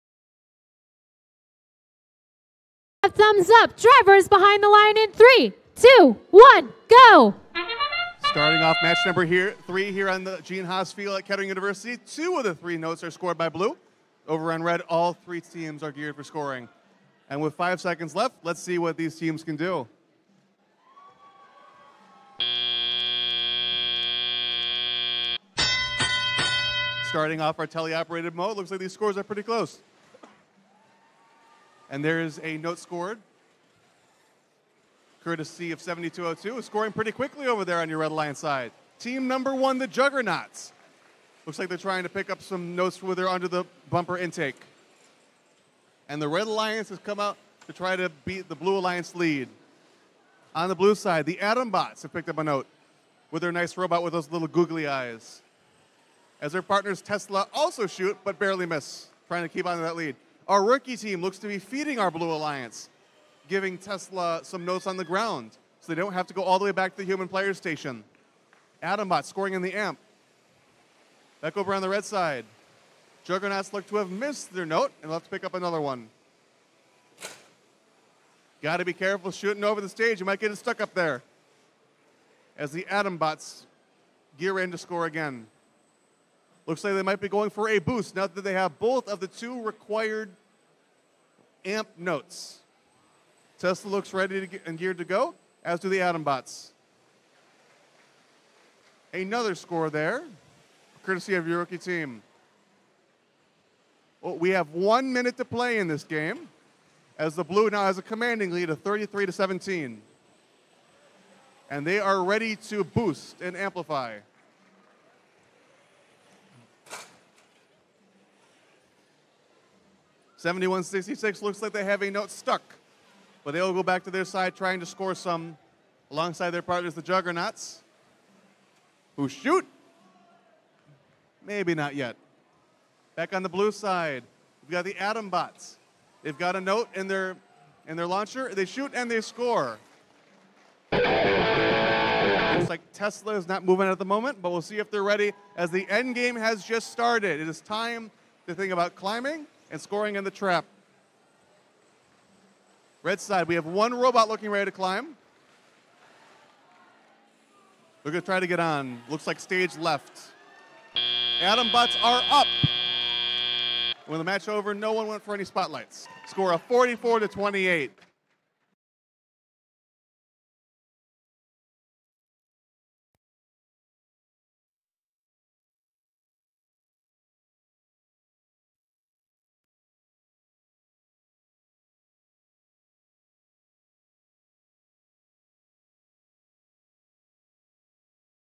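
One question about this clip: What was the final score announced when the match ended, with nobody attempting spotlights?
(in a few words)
44 to 28.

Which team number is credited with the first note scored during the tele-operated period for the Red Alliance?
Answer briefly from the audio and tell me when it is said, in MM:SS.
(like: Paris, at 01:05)
7202, at 00:35.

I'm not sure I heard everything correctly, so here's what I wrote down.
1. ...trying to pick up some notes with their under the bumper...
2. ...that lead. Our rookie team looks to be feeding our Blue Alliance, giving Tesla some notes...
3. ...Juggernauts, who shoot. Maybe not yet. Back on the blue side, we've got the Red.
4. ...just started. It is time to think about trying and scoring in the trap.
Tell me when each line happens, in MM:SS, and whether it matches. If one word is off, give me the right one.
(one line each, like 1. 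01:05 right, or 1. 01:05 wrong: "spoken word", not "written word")
1. 00:41 right
2. 00:59 right
3. 02:07 wrong: "Adambots", not "Red"
4. 02:26 wrong: "climbing", not "trying".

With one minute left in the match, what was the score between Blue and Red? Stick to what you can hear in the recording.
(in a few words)
33 to 17.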